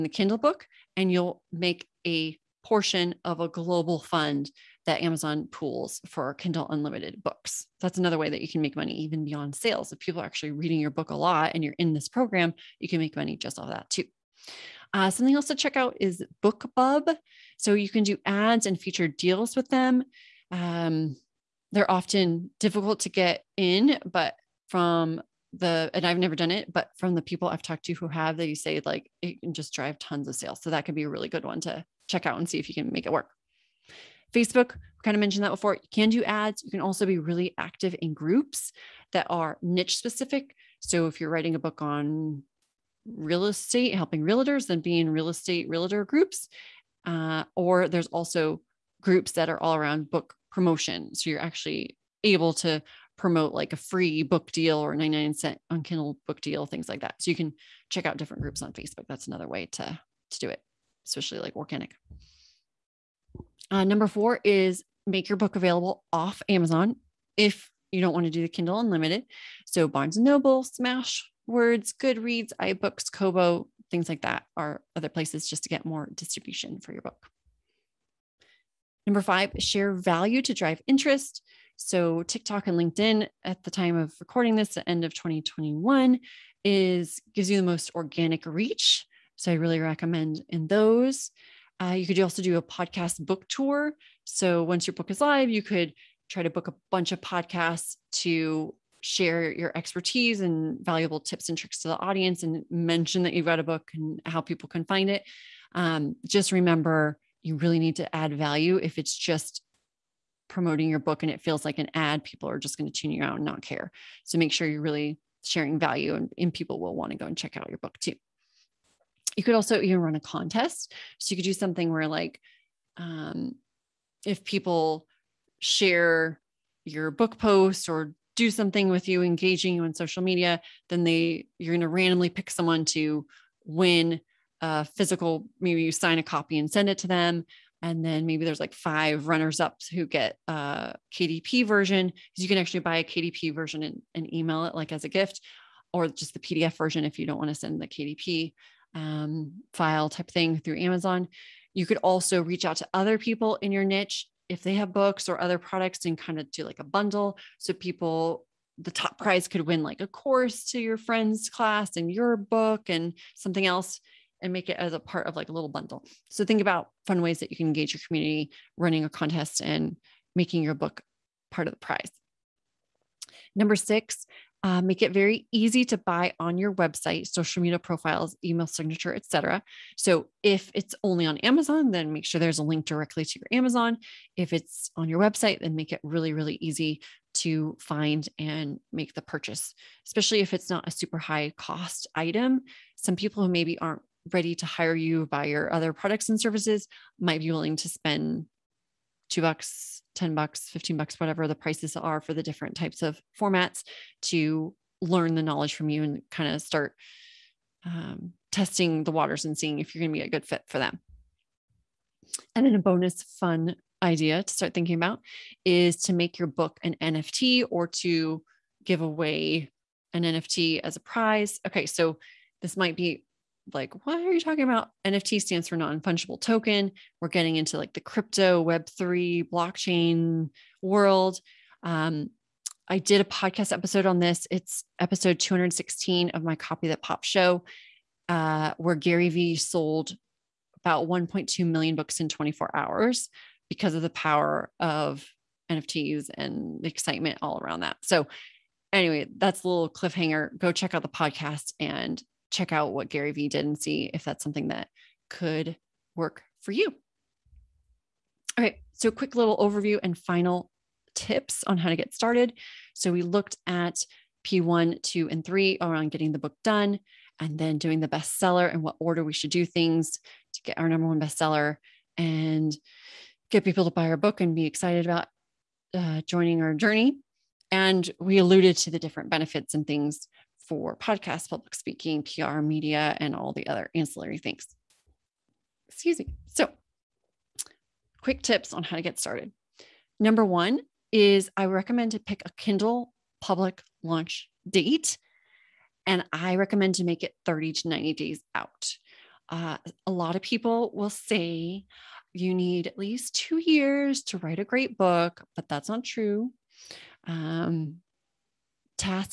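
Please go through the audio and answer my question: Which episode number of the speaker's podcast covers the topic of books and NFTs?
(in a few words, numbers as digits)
216.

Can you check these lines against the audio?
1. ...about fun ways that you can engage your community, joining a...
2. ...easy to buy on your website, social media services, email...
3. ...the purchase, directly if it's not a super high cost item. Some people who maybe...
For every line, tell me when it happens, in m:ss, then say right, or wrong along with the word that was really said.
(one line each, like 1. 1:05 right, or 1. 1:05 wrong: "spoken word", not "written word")
1. 2:46 wrong: "running", not "joining"
2. 2:55 wrong: "profiles", not "services"
3. 3:09 wrong: "especially", not "directly".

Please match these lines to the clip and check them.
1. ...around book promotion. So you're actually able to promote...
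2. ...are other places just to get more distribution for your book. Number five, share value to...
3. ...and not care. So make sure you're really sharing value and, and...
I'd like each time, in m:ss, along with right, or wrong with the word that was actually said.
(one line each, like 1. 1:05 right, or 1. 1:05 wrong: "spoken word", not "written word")
1. 0:49 right
2. 1:14 right
3. 1:53 right.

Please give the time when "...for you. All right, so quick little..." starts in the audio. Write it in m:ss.
4:16.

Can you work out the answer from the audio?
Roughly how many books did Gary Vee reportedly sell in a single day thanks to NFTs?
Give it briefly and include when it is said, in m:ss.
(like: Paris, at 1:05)
1.2 million, at 4:01.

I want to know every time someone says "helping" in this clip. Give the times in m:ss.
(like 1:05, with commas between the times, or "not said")
0:43.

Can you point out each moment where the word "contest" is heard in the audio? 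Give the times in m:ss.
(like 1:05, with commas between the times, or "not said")
2:00, 2:49.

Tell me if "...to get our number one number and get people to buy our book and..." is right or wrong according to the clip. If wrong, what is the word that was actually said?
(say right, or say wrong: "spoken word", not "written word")
wrong: "bestseller", not "number".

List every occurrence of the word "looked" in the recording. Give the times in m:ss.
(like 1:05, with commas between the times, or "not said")
4:23.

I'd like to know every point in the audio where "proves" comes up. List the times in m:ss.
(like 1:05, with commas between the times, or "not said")
not said.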